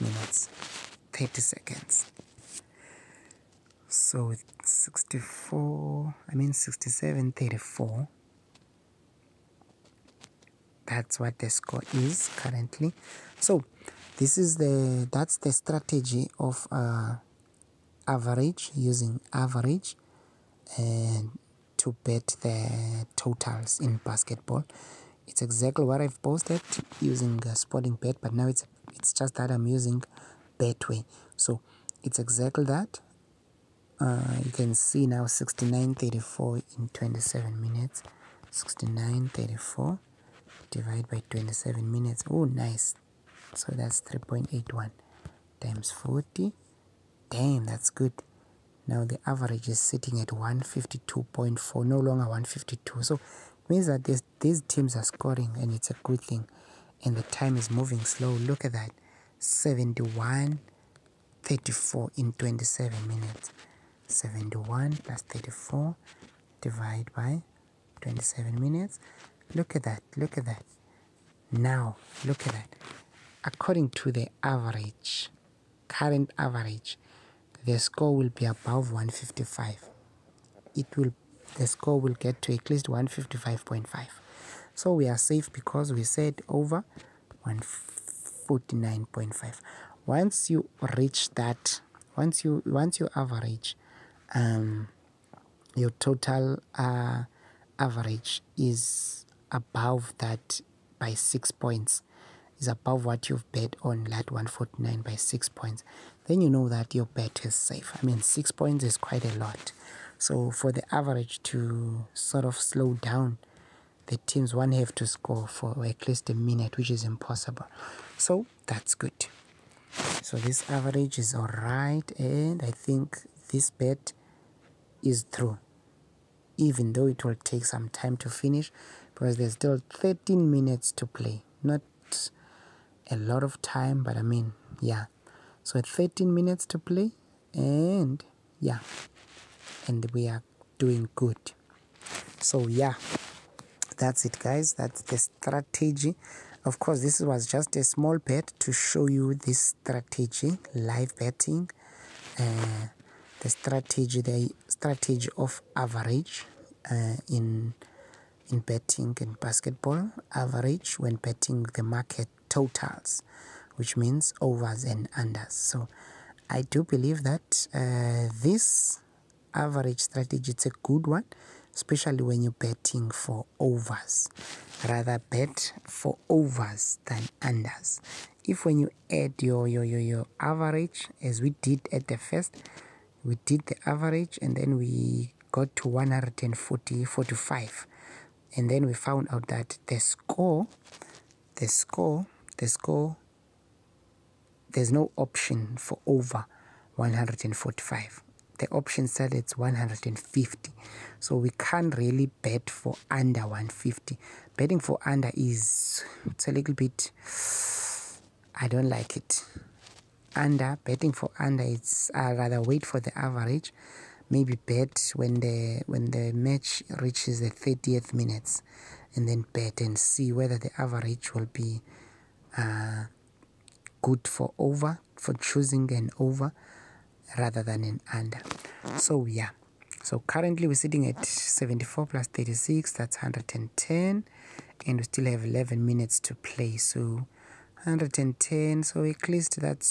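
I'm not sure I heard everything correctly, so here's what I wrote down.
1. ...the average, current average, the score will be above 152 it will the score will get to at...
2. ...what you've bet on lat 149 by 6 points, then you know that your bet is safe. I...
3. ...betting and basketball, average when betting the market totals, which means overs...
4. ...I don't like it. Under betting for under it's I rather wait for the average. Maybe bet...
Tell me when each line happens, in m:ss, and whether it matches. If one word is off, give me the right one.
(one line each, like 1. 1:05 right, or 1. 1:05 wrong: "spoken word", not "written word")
1. 1:14 wrong: "155", not "152"
2. 1:43 right
3. 2:38 right
4. 3:28 right.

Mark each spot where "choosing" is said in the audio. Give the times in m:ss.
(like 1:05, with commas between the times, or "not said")
3:45.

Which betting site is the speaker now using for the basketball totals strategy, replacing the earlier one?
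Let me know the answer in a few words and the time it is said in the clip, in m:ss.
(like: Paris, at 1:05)
Betway, at 0:30.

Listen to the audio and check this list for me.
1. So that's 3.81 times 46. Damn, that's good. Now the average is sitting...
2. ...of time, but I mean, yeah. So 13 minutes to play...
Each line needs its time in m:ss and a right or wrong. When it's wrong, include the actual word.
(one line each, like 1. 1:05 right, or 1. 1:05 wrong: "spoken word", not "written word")
1. 0:43 wrong: "40", not "46"
2. 2:13 right.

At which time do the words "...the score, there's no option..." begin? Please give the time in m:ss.
3:12.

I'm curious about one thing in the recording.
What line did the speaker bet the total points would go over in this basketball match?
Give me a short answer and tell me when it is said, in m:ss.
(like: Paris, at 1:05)
149.5, at 1:26.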